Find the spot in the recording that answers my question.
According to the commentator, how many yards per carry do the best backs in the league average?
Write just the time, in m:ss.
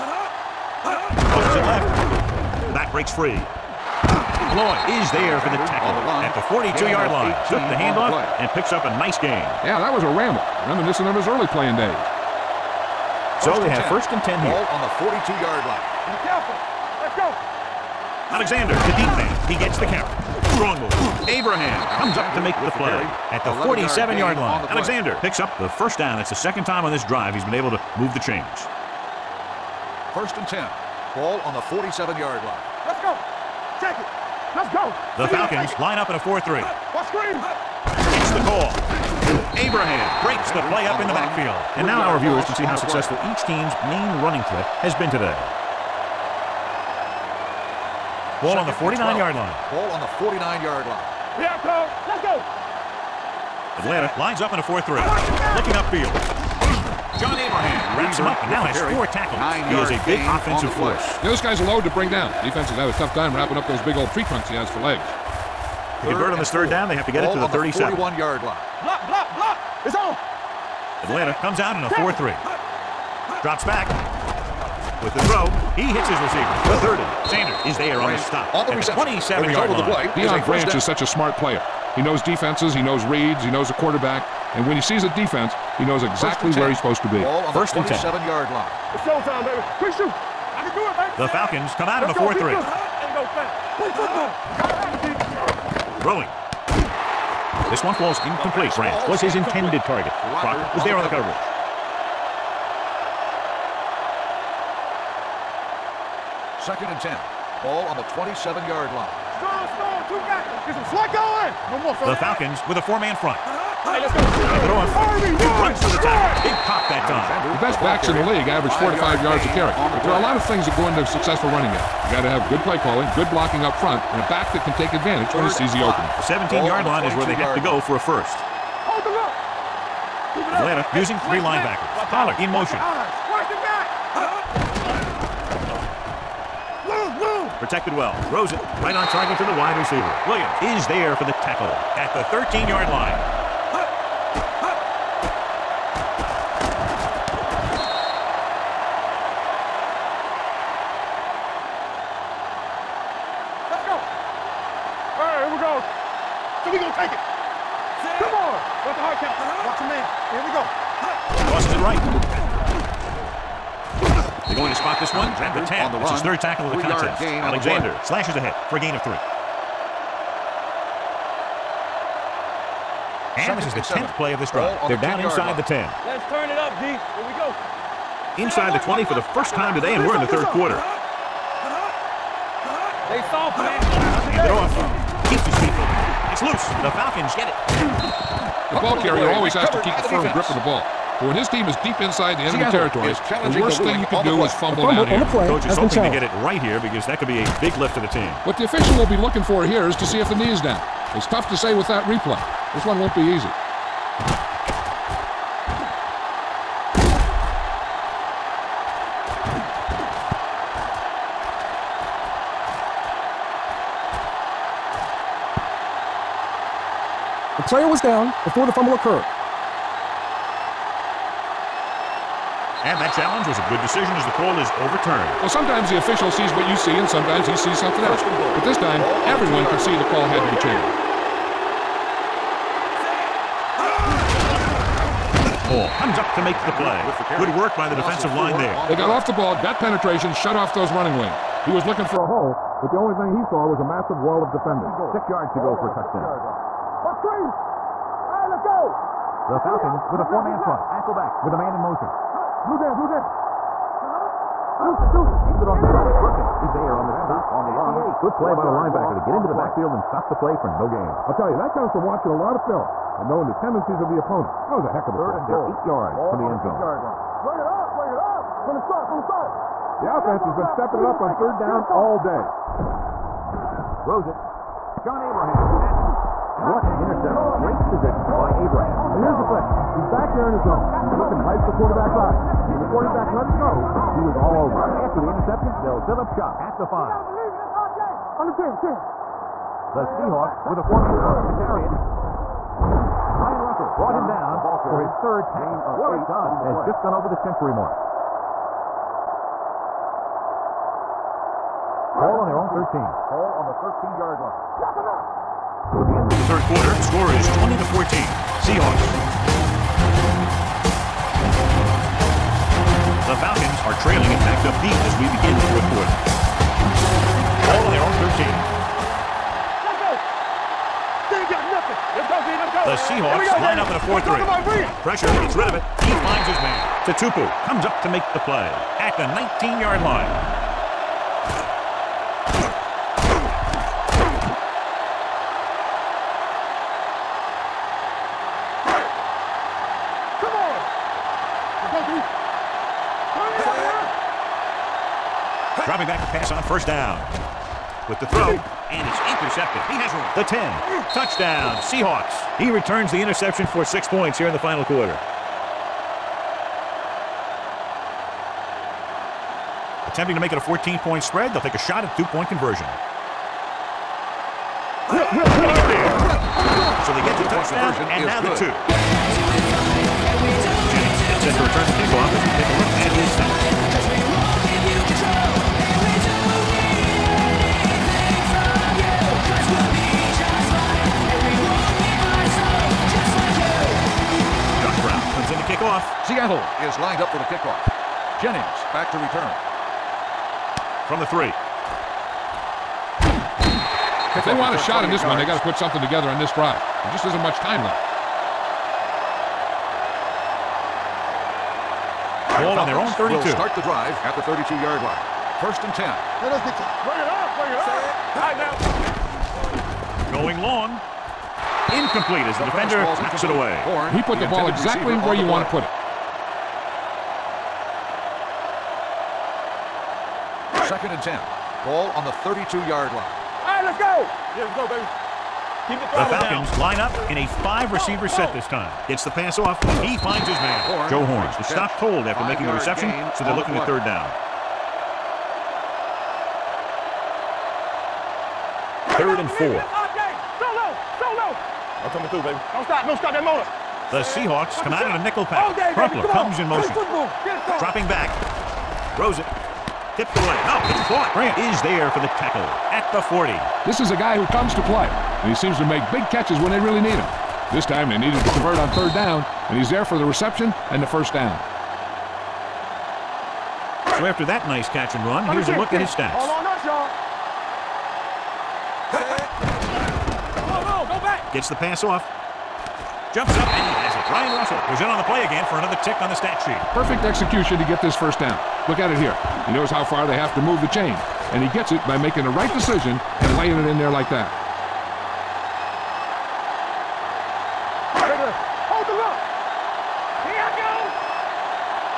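1:58.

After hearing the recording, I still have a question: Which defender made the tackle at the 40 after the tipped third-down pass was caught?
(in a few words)
Grant.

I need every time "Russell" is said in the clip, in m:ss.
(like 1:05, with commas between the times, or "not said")
4:53, 7:54.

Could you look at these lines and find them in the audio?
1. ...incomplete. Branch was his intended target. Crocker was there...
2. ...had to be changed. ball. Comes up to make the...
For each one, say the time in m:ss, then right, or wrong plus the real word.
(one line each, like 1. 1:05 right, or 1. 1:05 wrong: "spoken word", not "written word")
1. 1:38 right
2. 3:50 right.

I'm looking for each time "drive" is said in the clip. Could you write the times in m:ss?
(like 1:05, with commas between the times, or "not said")
0:27, 2:54, 6:36, 6:43.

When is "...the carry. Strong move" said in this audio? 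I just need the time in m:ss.
0:19.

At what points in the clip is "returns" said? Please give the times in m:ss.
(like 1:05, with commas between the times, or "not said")
5:52, 6:29.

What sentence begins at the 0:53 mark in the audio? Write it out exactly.
Atlanta lines up in a 4-3.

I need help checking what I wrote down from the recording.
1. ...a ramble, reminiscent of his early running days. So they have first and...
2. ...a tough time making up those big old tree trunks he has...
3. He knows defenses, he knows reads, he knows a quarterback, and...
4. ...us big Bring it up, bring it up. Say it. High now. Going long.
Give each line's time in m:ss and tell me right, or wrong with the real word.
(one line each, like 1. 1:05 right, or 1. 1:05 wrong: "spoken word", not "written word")
1. 0:10 wrong: "playing", not "running"
2. 1:02 wrong: "wrapping", not "making"
3. 1:21 right
4. 6:46 right.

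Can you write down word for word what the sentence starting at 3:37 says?
was down before the fumble occurred.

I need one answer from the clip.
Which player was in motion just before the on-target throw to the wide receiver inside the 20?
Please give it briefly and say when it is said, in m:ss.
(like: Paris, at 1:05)
Pollard, at 2:12.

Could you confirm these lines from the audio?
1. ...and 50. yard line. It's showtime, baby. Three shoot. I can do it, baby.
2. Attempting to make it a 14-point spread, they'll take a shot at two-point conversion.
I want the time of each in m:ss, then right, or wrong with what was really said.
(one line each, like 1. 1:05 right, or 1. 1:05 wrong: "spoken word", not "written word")
1. 1:27 wrong: "10", not "50"
2. 6:00 right.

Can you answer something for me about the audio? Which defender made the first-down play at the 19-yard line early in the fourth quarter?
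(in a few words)
Tatupu.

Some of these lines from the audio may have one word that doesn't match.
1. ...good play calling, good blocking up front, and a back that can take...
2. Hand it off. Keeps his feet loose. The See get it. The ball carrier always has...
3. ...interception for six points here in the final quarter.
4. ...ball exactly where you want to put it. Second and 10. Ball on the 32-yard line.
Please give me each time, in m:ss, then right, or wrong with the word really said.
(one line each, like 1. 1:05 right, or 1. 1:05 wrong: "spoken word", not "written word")
1. 2:02 right
2. 3:04 wrong: "Falcons", not "See"
3. 5:53 right
4. 6:54 right.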